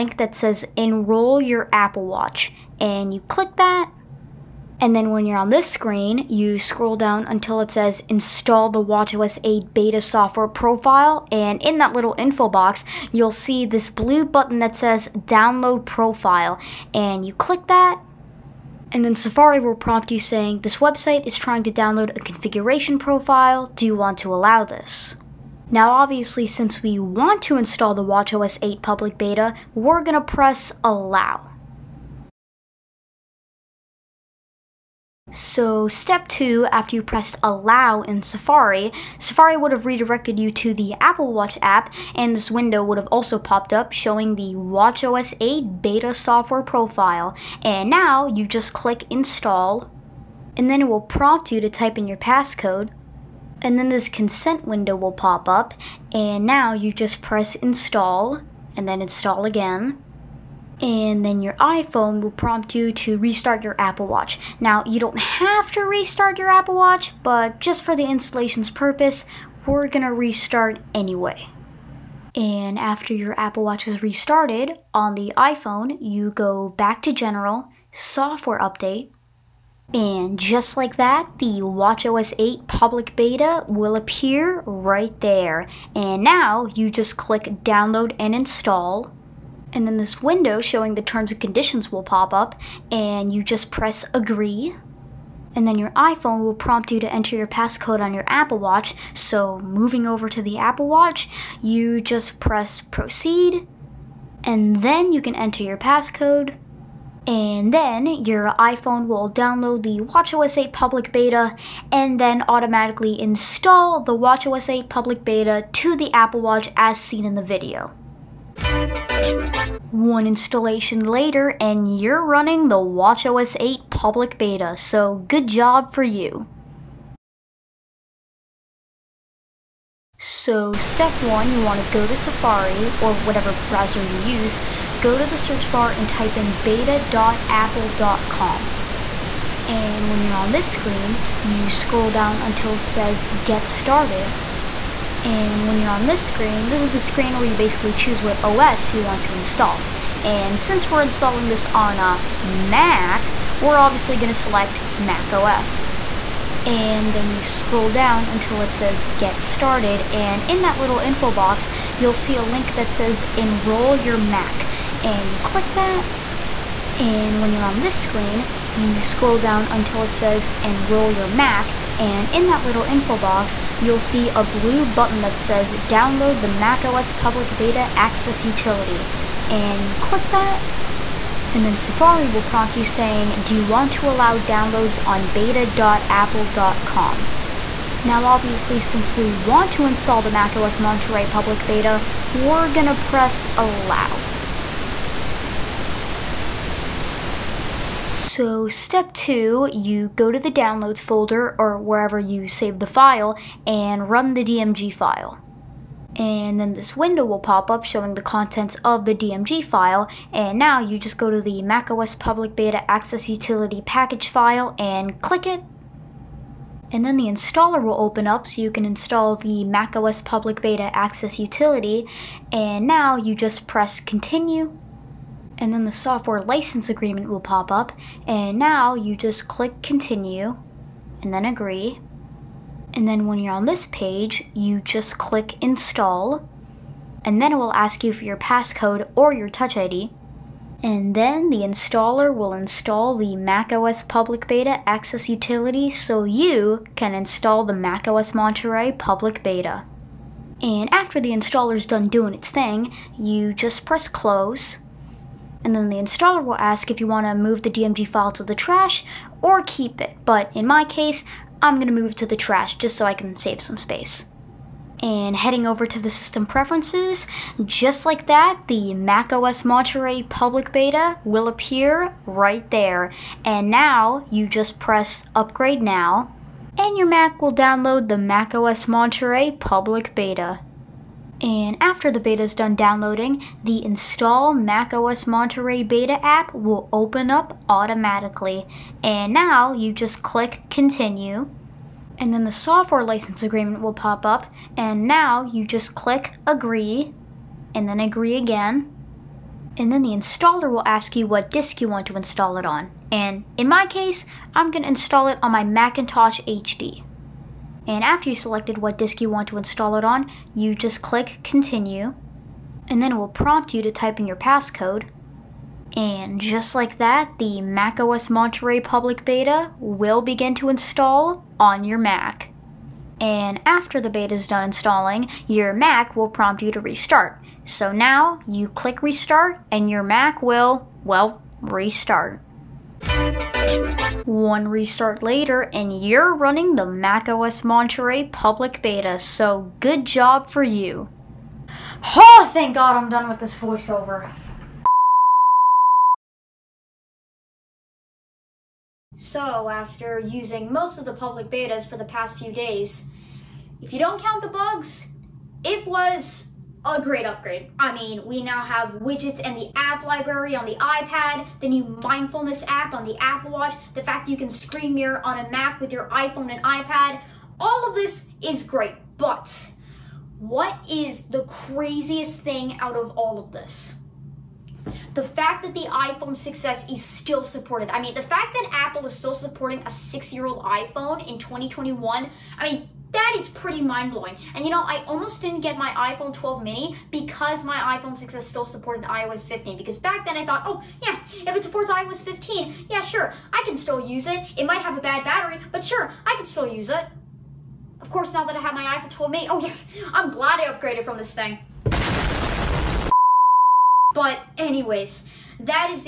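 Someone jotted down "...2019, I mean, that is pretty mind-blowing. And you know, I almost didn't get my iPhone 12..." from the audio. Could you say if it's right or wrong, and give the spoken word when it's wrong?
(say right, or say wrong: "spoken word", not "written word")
wrong: "2021", not "2019".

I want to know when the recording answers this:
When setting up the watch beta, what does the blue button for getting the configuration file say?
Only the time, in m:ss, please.
0:15.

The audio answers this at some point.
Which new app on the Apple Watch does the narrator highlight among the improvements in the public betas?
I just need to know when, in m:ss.
6:02.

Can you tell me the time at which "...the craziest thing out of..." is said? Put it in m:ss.
6:11.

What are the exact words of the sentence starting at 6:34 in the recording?
It might have a bad battery, but sure, I can still use it.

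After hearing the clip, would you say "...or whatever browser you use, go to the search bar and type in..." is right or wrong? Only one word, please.
right.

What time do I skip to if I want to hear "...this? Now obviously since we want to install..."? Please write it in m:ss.
0:24.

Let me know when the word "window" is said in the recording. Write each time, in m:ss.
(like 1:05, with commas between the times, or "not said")
0:42, 0:54, 1:30, 3:26.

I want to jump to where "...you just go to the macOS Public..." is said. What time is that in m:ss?
3:30.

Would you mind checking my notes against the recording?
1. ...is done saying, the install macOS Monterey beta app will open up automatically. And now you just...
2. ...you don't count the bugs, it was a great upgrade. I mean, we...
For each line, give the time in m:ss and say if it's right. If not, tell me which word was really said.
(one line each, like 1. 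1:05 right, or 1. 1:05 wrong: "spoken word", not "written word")
1. 4:42 wrong: "downloading", not "saying"
2. 5:53 right.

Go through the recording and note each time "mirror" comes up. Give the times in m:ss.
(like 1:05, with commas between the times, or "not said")
6:04.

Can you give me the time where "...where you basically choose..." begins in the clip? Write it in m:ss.
2:27.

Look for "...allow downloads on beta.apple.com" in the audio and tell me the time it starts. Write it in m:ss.
3:04.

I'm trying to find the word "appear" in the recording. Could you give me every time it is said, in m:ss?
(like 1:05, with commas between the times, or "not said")
1:23, 4:31.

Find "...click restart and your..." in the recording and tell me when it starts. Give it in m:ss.
5:28.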